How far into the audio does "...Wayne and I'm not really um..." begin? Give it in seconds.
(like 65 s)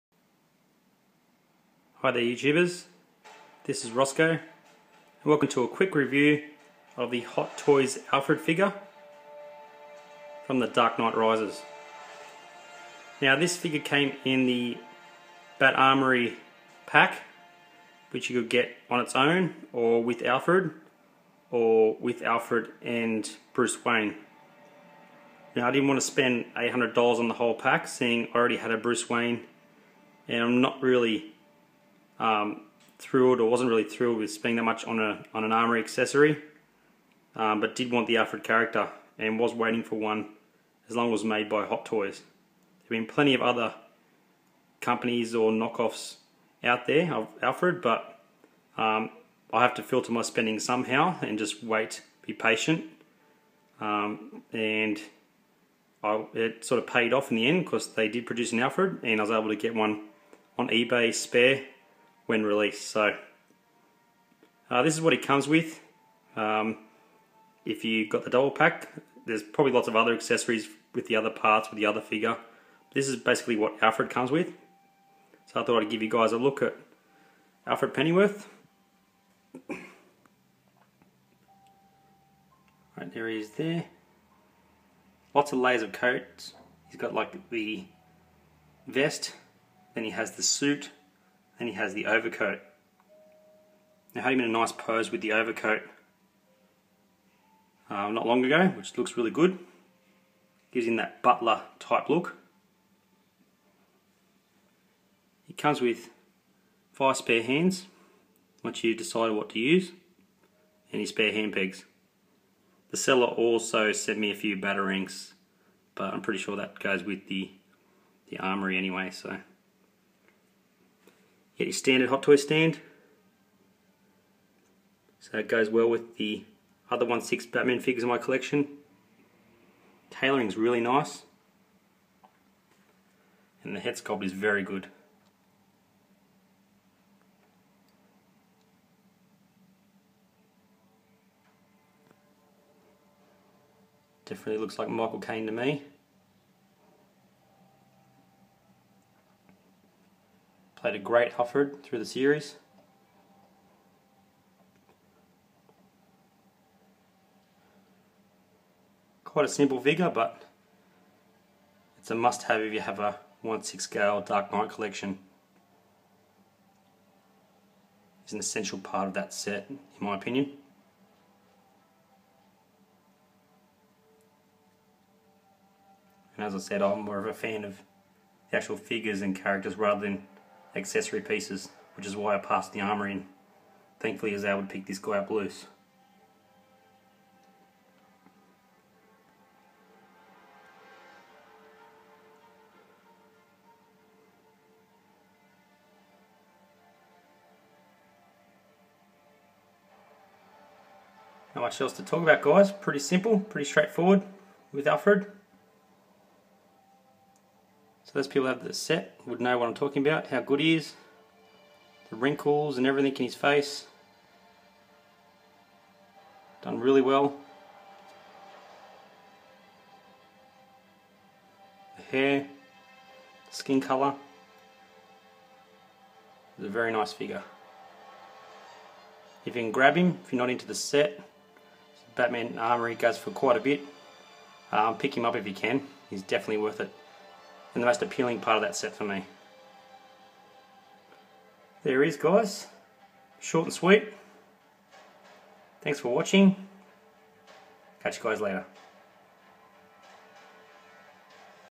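29 s.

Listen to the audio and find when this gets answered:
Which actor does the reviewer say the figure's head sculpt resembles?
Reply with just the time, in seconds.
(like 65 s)
144 s.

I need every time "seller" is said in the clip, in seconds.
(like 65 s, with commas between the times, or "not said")
112 s.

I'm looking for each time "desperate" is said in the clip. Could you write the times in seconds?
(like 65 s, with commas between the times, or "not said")
not said.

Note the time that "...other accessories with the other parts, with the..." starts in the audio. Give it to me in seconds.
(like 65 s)
69 s.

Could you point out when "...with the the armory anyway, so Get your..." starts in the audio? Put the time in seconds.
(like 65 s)
117 s.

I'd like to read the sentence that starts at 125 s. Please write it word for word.
So it goes well with the other 1-6 Batman figures in my collection.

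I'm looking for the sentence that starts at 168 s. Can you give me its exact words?
It's an essential part of that set, in my opinion.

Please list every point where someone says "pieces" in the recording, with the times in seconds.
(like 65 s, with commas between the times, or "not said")
181 s.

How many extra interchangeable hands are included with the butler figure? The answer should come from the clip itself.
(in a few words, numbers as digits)
5.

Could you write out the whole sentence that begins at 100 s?
Gives him that butler type look.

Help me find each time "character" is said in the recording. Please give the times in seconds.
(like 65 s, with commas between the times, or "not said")
38 s, 179 s.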